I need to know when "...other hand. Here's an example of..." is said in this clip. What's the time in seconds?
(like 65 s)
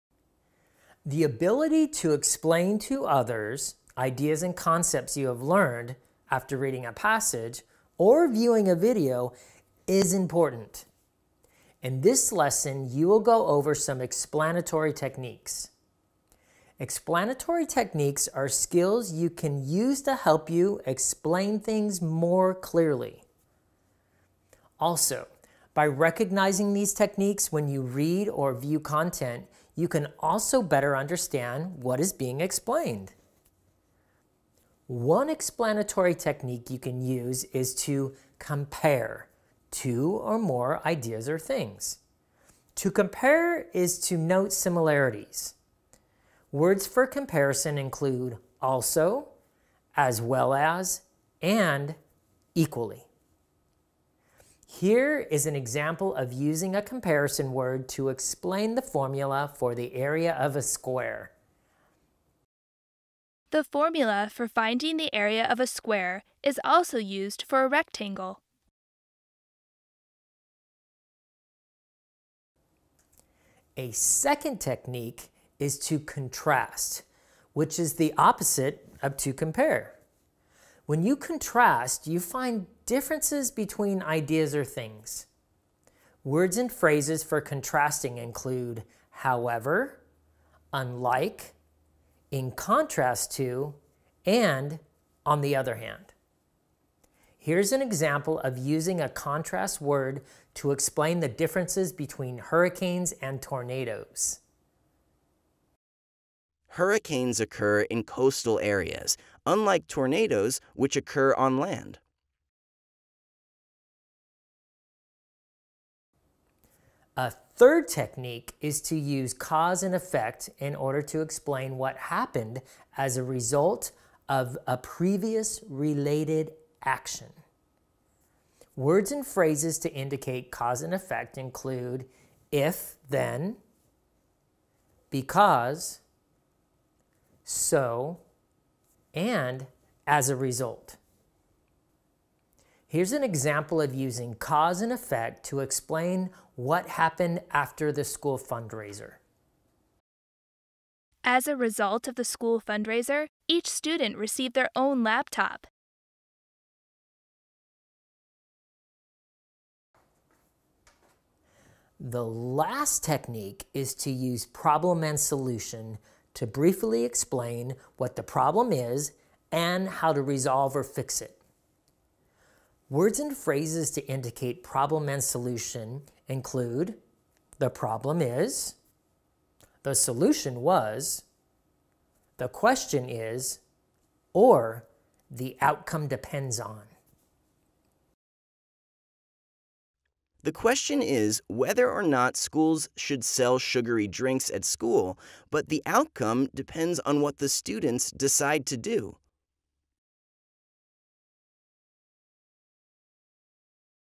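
95 s.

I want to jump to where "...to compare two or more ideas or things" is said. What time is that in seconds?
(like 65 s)
37 s.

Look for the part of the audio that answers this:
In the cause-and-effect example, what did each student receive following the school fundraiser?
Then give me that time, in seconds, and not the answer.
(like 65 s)
154 s.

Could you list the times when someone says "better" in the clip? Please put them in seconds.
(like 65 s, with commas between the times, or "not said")
30 s.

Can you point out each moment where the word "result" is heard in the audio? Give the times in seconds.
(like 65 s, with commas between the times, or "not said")
123 s, 140 s, 151 s.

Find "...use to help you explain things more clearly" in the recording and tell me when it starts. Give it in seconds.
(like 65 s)
19 s.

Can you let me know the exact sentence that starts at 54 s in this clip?
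Here is an example of using a comparison word to explain the formula for the area of a square.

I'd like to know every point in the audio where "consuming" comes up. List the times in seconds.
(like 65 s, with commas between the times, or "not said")
not said.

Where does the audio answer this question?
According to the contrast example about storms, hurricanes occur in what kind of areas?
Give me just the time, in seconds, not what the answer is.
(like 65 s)
108 s.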